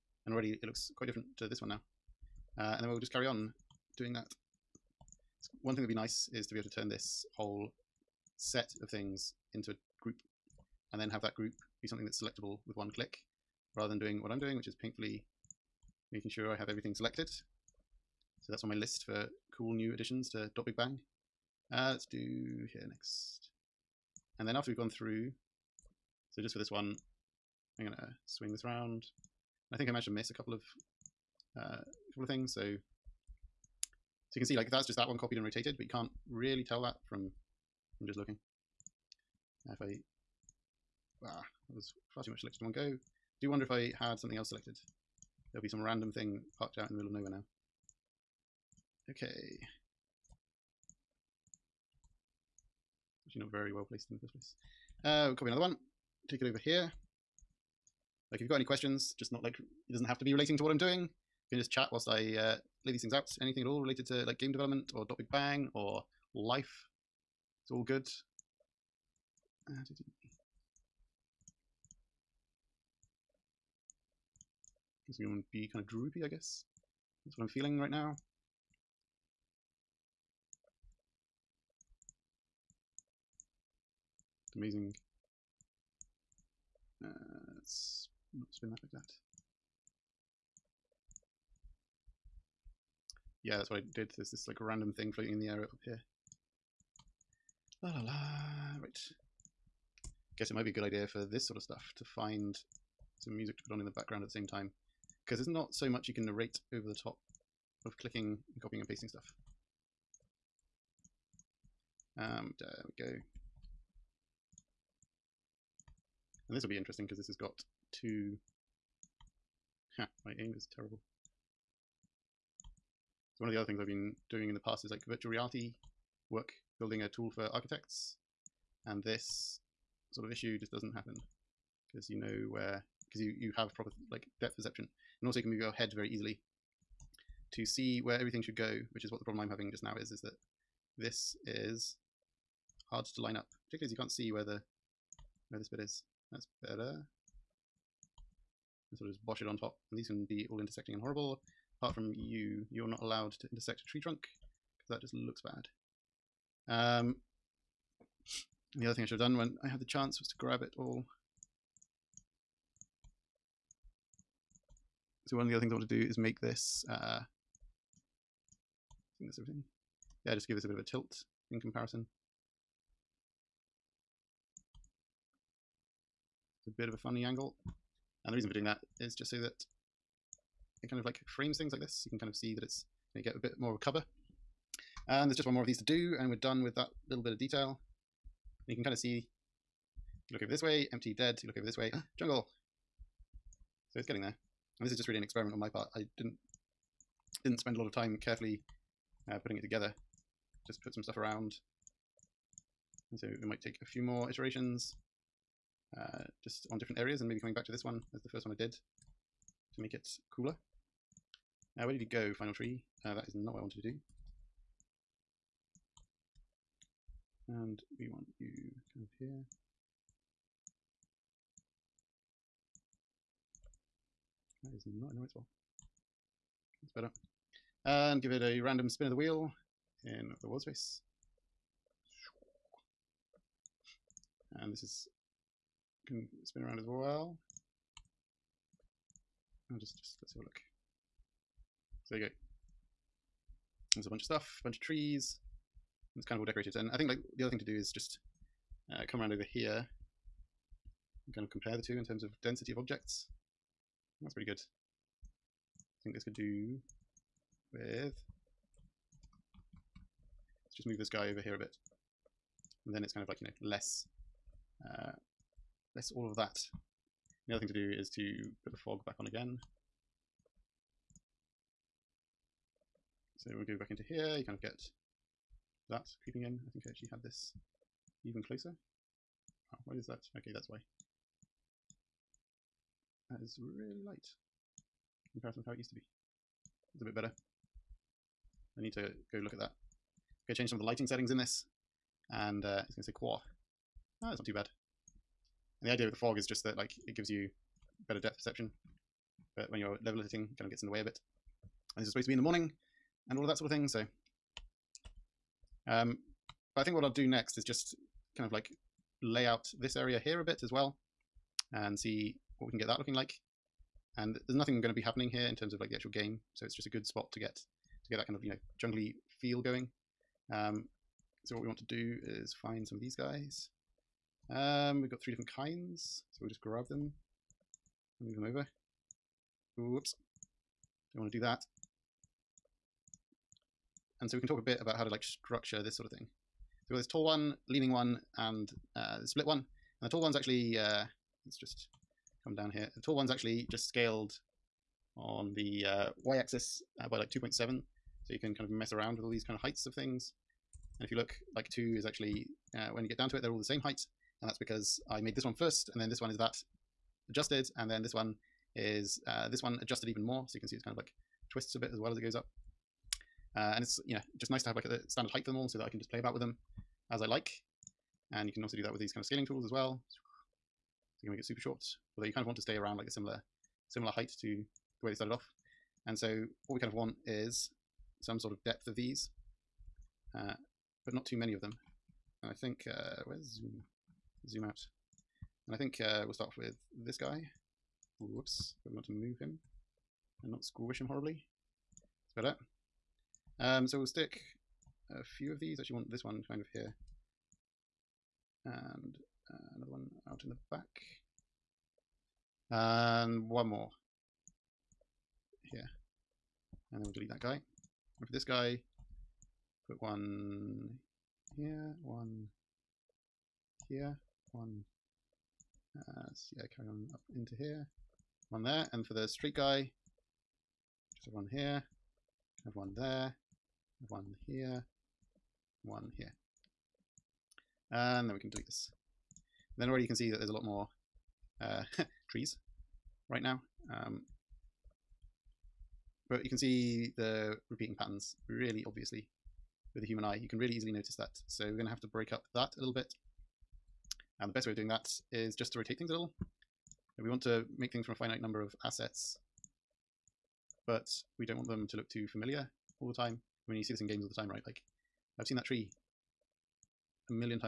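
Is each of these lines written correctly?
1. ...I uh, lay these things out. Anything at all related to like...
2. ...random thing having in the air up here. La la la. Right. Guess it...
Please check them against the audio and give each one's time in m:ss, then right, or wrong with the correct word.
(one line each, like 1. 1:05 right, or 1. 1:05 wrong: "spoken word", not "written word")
1. 1:02 right
2. 1:34 wrong: "floating", not "having".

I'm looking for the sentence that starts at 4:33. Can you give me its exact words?
So when we go back into here, you kind of get that creeping in.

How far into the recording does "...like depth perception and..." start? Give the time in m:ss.
2:14.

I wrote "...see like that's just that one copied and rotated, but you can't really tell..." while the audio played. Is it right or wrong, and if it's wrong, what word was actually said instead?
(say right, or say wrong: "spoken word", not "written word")
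right.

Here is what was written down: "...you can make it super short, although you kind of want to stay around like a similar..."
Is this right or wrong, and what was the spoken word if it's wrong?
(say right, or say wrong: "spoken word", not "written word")
right.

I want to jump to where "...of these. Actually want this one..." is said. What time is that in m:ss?
6:35.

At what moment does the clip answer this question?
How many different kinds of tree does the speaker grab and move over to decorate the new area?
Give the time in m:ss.
5:25.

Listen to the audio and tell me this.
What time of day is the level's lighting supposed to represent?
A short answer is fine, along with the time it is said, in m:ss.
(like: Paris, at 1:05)
Morning, at 5:02.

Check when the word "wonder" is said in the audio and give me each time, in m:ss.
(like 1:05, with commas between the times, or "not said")
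0:43.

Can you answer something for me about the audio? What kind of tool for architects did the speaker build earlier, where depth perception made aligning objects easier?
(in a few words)
Virtual reality.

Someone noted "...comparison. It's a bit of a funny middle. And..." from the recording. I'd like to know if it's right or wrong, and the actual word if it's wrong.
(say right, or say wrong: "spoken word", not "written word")
wrong: "angle", not "middle".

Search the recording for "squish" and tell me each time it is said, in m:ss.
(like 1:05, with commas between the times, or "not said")
6:30.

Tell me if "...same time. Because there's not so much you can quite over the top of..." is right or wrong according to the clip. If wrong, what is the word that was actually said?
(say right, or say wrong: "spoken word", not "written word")
wrong: "narrate", not "quite".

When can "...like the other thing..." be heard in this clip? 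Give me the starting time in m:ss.
4:07.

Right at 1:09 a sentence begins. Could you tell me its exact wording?
Uh, going to be kind of droopy, I guess.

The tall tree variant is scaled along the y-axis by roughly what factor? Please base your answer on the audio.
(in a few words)
2.7.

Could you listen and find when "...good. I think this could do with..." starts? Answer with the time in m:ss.
4:14.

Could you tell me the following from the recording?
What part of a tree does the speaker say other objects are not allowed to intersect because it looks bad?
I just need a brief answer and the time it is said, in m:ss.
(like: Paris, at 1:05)
Tree trunk, at 2:33.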